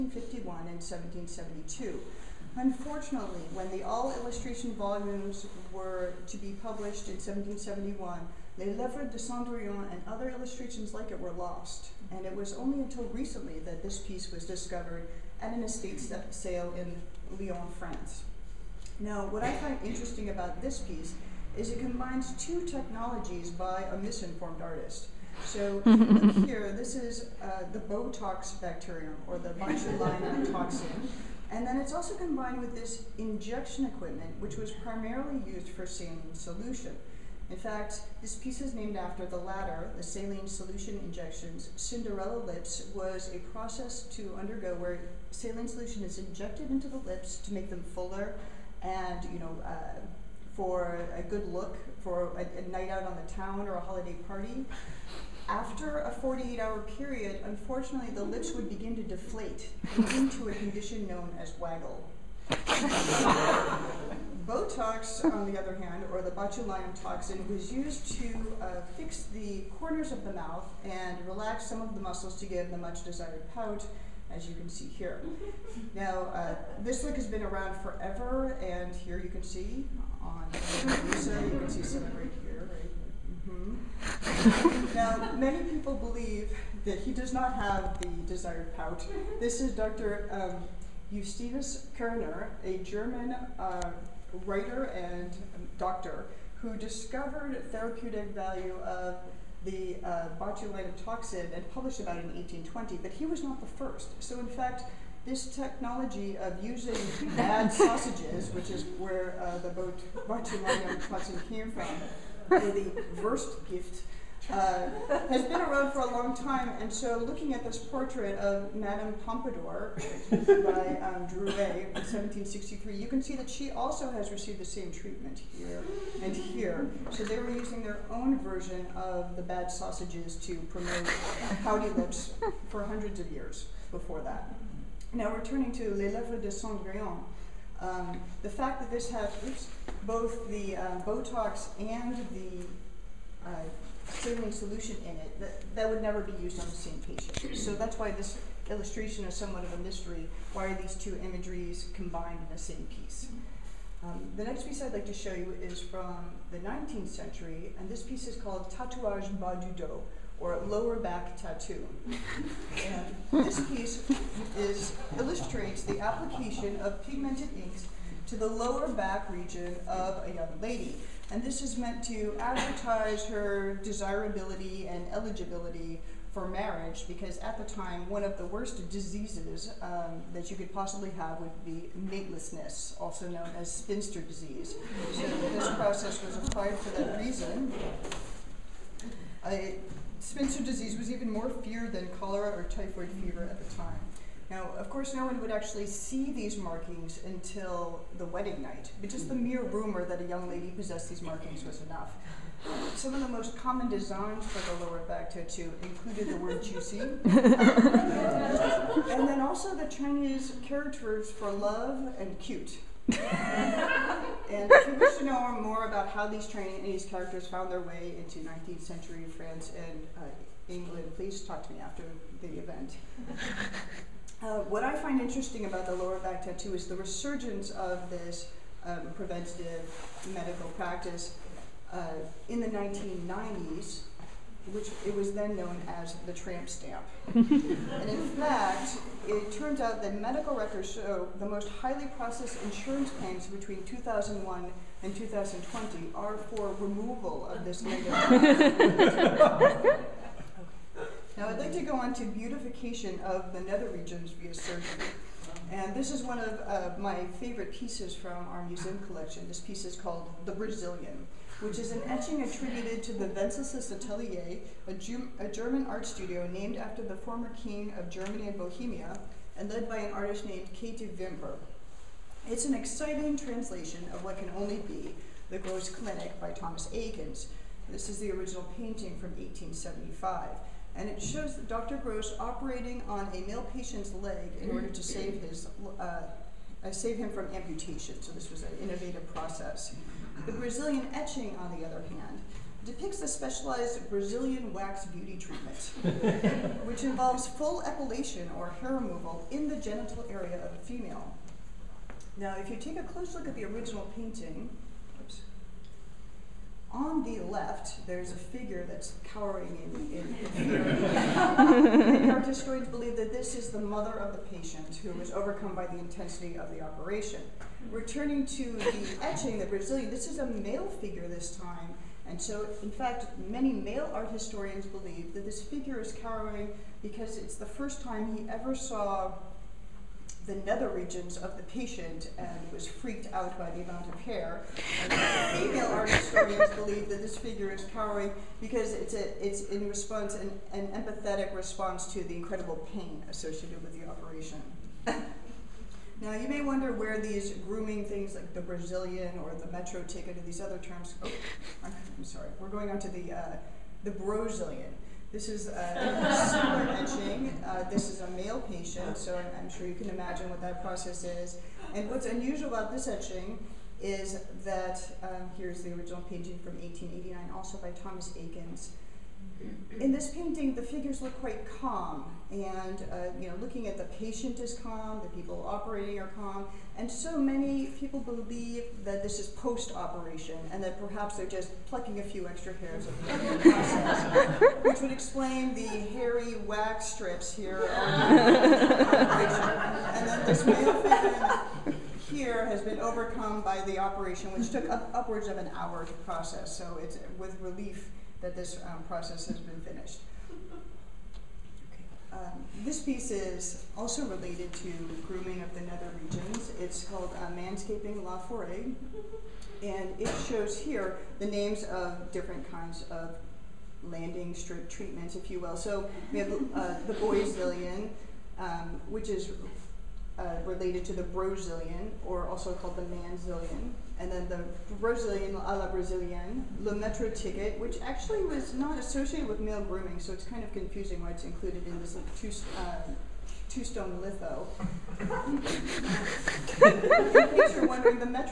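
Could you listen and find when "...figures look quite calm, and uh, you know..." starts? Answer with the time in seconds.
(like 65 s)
370 s.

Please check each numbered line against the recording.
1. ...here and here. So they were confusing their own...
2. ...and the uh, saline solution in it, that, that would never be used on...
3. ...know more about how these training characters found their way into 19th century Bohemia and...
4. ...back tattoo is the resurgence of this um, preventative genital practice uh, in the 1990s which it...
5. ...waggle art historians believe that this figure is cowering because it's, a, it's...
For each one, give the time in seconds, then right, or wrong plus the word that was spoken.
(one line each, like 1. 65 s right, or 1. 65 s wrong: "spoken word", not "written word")
1. 125 s wrong: "using", not "confusing"
2. 141 s right
3. 215 s wrong: "France", not "Bohemia"
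4. 226 s wrong: "medical", not "genital"
5. 335 s wrong: "female", not "waggle".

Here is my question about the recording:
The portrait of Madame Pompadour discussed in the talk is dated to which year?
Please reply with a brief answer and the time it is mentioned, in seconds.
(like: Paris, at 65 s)
1763, at 121 s.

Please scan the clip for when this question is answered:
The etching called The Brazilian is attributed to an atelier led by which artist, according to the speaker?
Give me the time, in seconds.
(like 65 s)
270 s.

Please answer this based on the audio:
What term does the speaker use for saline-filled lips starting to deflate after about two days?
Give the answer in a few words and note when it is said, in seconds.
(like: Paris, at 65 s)
waggle, at 61 s.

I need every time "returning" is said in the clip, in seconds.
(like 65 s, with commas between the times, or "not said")
135 s, 317 s.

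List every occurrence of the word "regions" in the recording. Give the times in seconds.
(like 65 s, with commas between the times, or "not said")
169 s, 253 s, 330 s, 406 s.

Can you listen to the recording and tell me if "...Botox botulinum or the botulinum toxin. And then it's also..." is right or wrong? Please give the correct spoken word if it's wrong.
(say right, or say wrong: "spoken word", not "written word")
wrong: "bacterium", not "botulinum".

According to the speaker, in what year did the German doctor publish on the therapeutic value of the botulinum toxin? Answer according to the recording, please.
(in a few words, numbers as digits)
1820.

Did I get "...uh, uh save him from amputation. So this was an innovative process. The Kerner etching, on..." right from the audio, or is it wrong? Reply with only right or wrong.
wrong.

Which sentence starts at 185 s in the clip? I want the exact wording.
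So this process was applied for that reason.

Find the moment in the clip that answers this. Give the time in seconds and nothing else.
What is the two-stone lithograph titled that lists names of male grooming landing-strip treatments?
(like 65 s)
407 s.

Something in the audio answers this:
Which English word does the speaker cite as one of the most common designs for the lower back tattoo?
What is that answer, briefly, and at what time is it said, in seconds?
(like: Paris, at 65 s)
juicy, at 206 s.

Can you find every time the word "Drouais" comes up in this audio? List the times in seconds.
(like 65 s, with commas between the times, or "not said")
121 s.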